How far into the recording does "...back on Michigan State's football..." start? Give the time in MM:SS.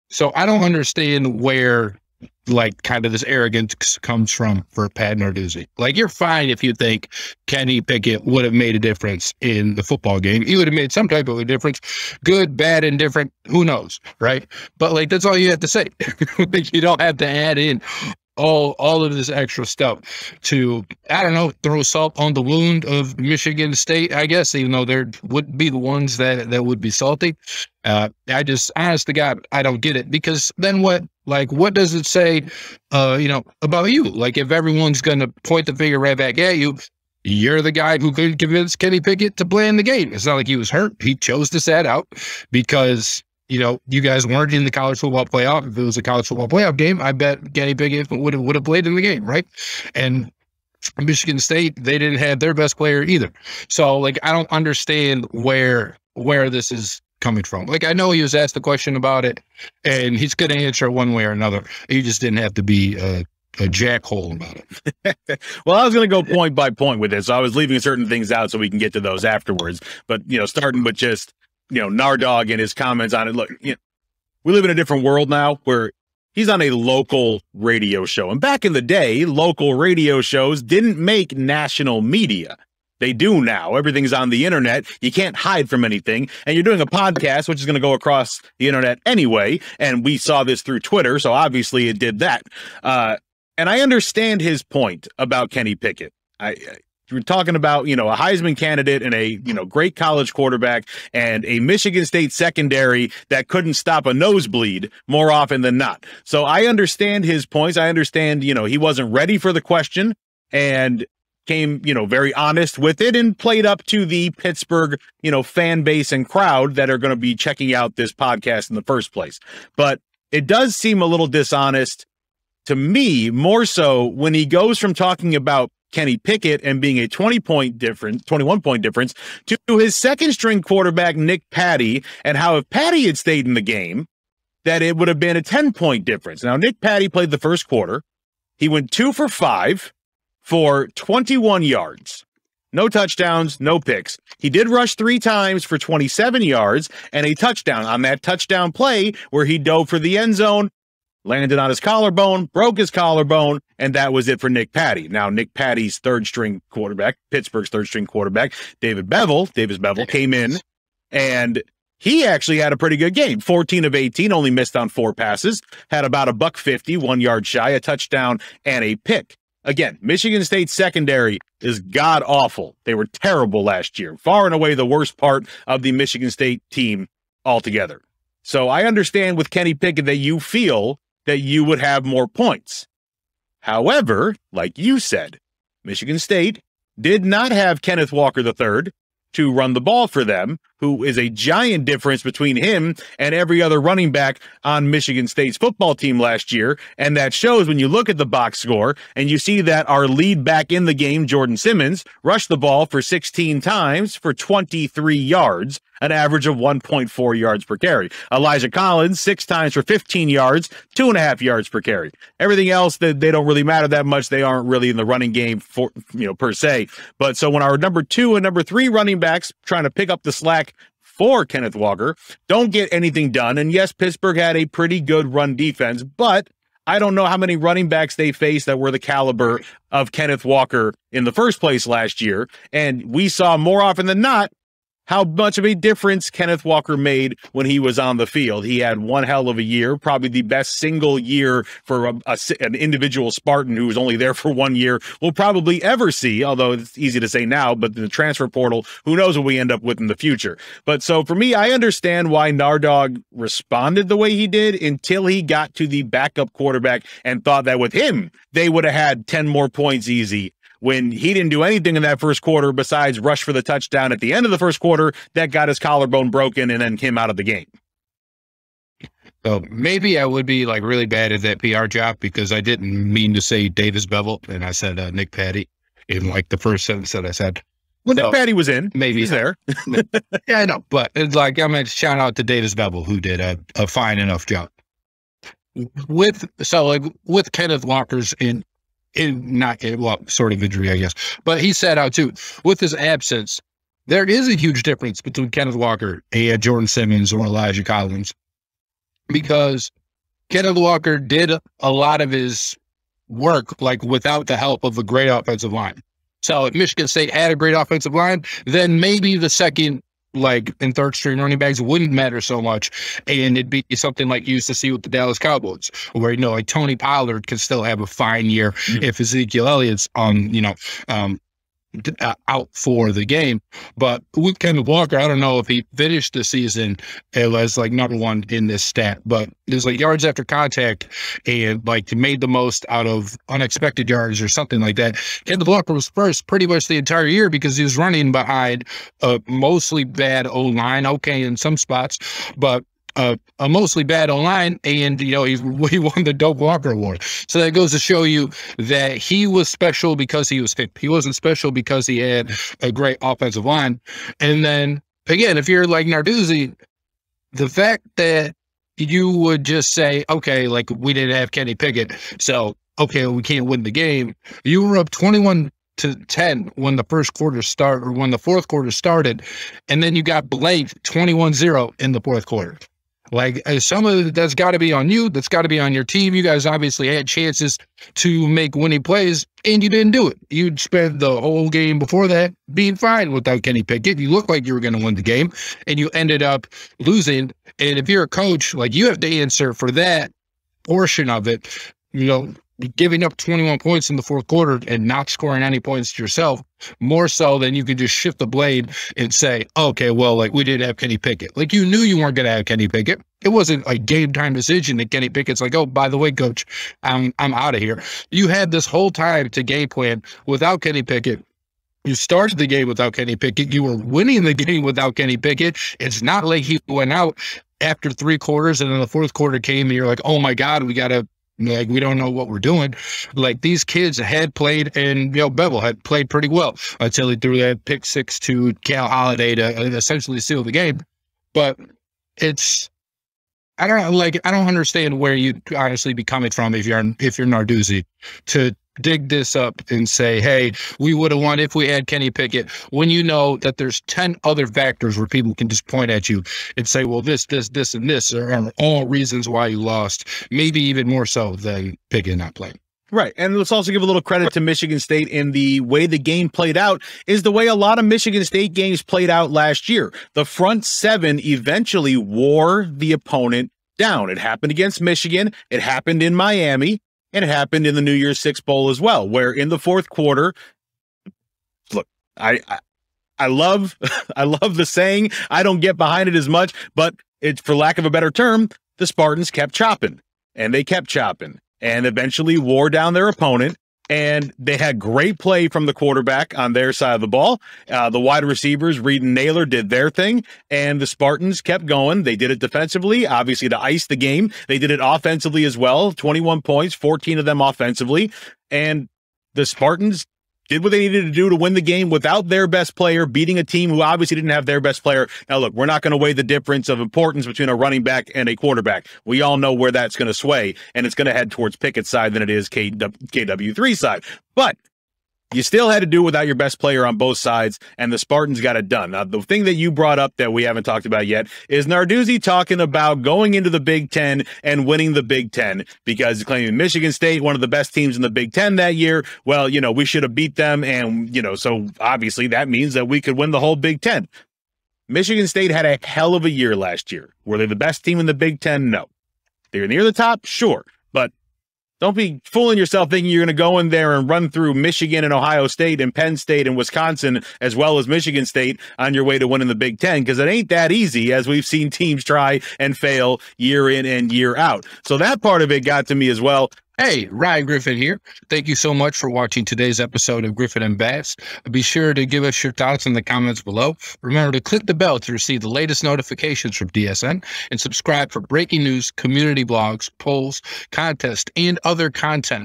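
03:14.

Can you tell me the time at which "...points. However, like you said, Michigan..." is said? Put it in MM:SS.
03:02.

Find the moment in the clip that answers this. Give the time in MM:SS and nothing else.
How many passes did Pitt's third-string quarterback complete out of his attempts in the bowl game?
02:43.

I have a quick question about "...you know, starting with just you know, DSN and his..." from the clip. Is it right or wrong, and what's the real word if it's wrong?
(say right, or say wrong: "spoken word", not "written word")
wrong: "Nardog", not "DSN".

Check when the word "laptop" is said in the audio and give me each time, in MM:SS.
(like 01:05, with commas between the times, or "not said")
not said.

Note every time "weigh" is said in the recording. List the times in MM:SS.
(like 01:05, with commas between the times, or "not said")
08:26.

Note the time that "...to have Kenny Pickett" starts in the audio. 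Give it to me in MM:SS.
06:42.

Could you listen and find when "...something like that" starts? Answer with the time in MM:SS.
05:34.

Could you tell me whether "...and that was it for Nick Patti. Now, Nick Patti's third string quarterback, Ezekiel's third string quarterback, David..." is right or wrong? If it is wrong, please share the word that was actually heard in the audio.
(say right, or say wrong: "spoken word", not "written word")
wrong: "Pittsburgh", not "Ezekiel".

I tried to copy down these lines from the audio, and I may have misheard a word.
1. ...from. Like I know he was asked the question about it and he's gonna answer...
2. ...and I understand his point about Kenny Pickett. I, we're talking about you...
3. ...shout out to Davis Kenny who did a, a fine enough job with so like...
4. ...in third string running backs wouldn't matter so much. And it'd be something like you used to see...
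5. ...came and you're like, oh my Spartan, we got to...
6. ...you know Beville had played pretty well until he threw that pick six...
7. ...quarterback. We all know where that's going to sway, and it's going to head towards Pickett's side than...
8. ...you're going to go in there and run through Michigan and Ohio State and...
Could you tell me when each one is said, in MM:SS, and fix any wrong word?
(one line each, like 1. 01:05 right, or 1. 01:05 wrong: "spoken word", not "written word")
1. 00:57 right
2. 01:33 right
3. 04:41 wrong: "Beville", not "Kenny"
4. 05:10 right
5. 06:59 wrong: "God", not "Spartan"
6. 07:05 right
7. 08:28 right
8. 09:03 right.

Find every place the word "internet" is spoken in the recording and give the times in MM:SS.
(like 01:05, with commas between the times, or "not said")
01:24, 01:28.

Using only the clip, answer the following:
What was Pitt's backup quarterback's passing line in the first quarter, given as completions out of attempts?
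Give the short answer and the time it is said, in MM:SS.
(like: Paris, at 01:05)
2 for 5, at 02:18.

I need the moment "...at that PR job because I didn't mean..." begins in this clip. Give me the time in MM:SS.
04:31.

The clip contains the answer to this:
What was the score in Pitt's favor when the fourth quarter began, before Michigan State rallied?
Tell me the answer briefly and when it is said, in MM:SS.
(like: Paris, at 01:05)
21 to 10, at 06:05.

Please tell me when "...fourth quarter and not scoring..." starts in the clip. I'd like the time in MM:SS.
06:34.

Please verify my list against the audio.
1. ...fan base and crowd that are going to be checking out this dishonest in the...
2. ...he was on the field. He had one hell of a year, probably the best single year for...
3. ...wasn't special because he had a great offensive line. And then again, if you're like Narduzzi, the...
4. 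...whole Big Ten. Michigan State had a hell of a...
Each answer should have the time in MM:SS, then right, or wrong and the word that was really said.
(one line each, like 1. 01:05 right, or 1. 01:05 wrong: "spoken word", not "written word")
1. 01:55 wrong: "podcast", not "dishonest"
2. 03:57 right
3. 05:51 right
4. 08:53 right.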